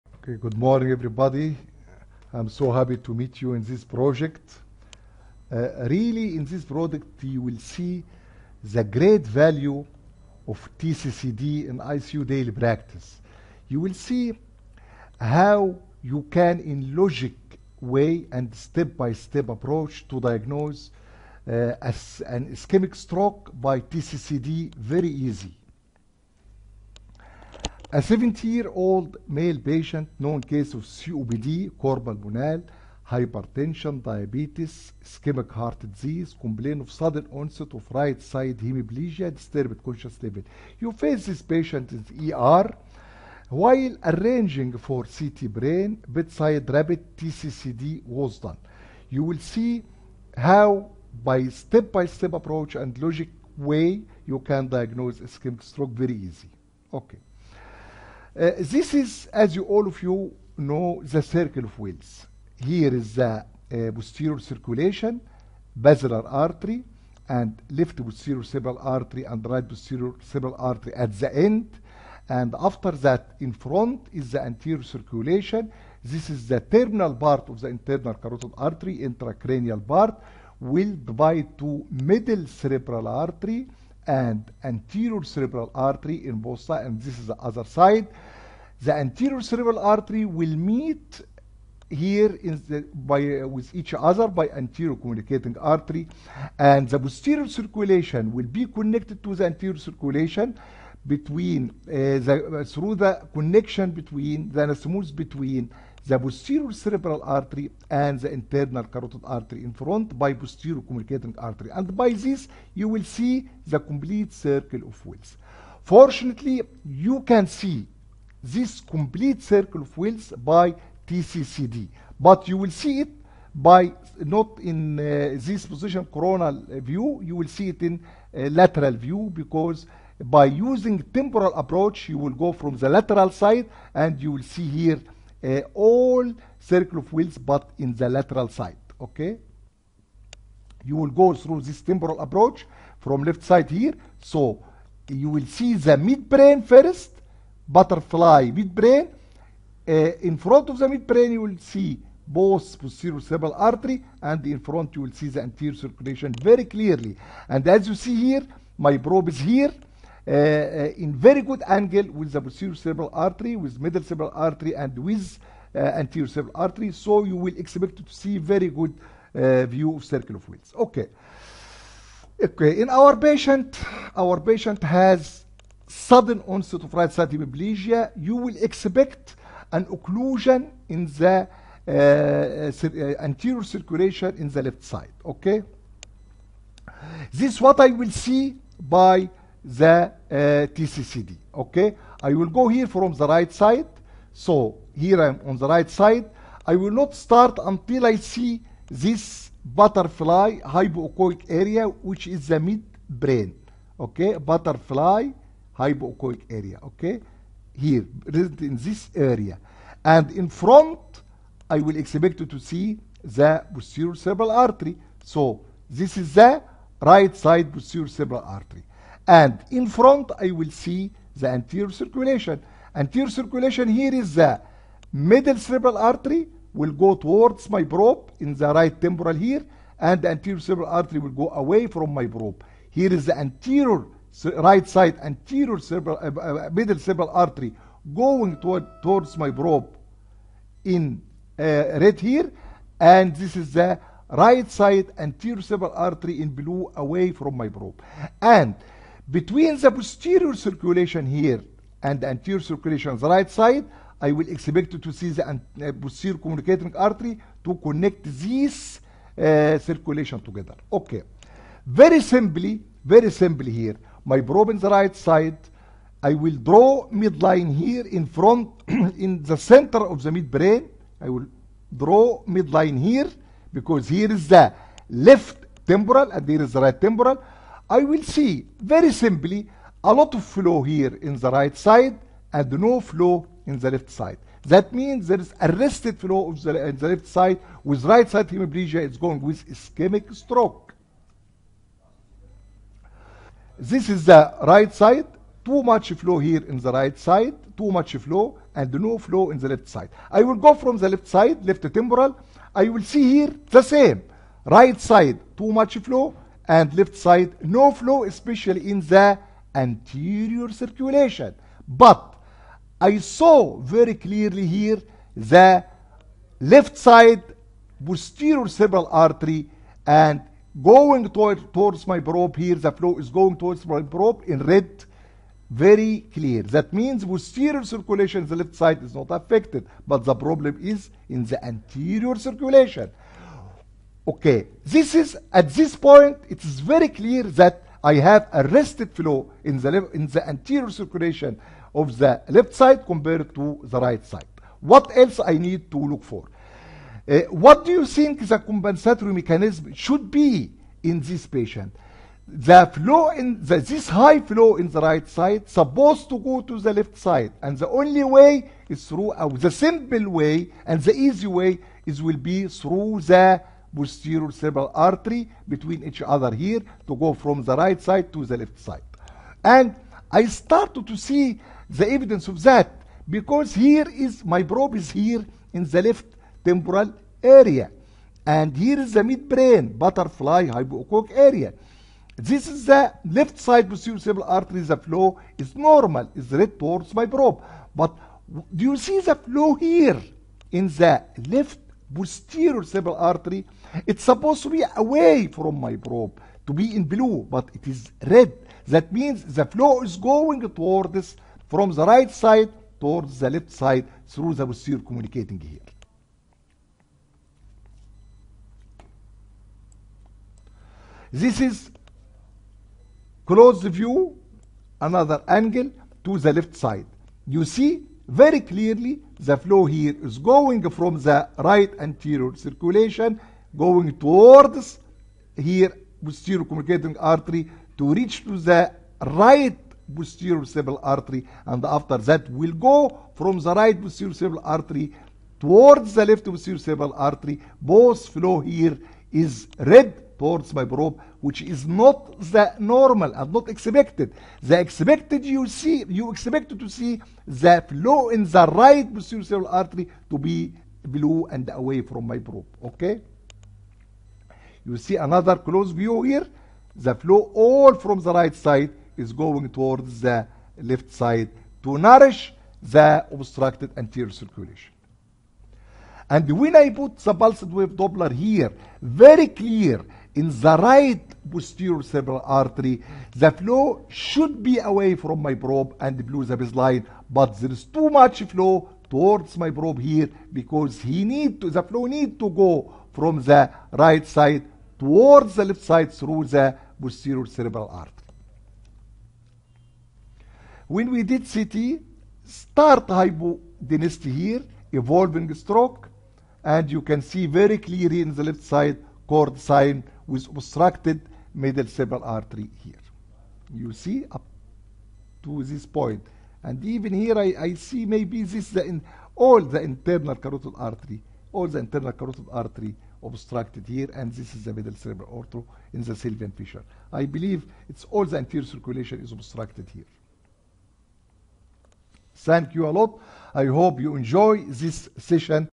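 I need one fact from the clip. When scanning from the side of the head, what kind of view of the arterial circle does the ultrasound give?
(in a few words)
Lateral view.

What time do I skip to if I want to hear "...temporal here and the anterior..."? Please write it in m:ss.
3:49.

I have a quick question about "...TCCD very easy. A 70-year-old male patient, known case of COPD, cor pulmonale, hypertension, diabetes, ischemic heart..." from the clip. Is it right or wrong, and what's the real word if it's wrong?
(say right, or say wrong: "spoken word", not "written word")
right.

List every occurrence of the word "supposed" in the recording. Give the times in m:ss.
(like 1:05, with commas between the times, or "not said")
5:55, 6:34.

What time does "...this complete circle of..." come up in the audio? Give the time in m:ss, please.
1:58.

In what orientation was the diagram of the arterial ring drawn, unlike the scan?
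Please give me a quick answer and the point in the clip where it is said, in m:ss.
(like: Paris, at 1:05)
Coronal view, at 2:06.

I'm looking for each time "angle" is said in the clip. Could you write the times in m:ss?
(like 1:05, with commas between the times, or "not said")
2:41, 6:55.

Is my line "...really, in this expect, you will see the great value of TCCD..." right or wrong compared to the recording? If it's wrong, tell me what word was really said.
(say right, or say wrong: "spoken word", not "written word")
wrong: "project", not "expect".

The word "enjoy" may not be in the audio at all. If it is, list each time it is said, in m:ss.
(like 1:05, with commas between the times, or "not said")
8:44.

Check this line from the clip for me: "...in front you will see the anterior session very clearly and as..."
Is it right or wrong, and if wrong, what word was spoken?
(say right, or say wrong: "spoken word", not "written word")
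wrong: "circulation", not "session".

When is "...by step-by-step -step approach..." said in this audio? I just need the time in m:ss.
0:51.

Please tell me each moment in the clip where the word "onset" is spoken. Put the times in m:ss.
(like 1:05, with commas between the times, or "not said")
0:37, 2:56.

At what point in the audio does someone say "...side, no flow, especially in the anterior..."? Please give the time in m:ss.
5:07.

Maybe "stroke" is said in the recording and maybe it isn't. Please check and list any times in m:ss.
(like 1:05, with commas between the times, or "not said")
0:22, 0:55, 4:50, 8:15.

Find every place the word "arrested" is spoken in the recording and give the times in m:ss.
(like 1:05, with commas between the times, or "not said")
4:45, 5:38.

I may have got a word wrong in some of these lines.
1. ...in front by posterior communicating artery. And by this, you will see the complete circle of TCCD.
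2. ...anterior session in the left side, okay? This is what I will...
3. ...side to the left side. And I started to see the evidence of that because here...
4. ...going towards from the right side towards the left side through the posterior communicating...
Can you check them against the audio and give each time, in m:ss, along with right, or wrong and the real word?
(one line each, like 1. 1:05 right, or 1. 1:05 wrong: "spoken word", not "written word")
1. 1:49 wrong: "Willis", not "TCCD"
2. 3:03 wrong: "circulation", not "session"
3. 6:08 right
4. 6:40 right.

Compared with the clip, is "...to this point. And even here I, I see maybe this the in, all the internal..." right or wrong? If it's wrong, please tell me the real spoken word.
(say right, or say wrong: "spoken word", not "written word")
right.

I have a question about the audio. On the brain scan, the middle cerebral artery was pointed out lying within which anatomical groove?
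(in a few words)
Sylvian fissure.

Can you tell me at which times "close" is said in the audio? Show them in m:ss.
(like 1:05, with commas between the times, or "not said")
6:53, 7:35.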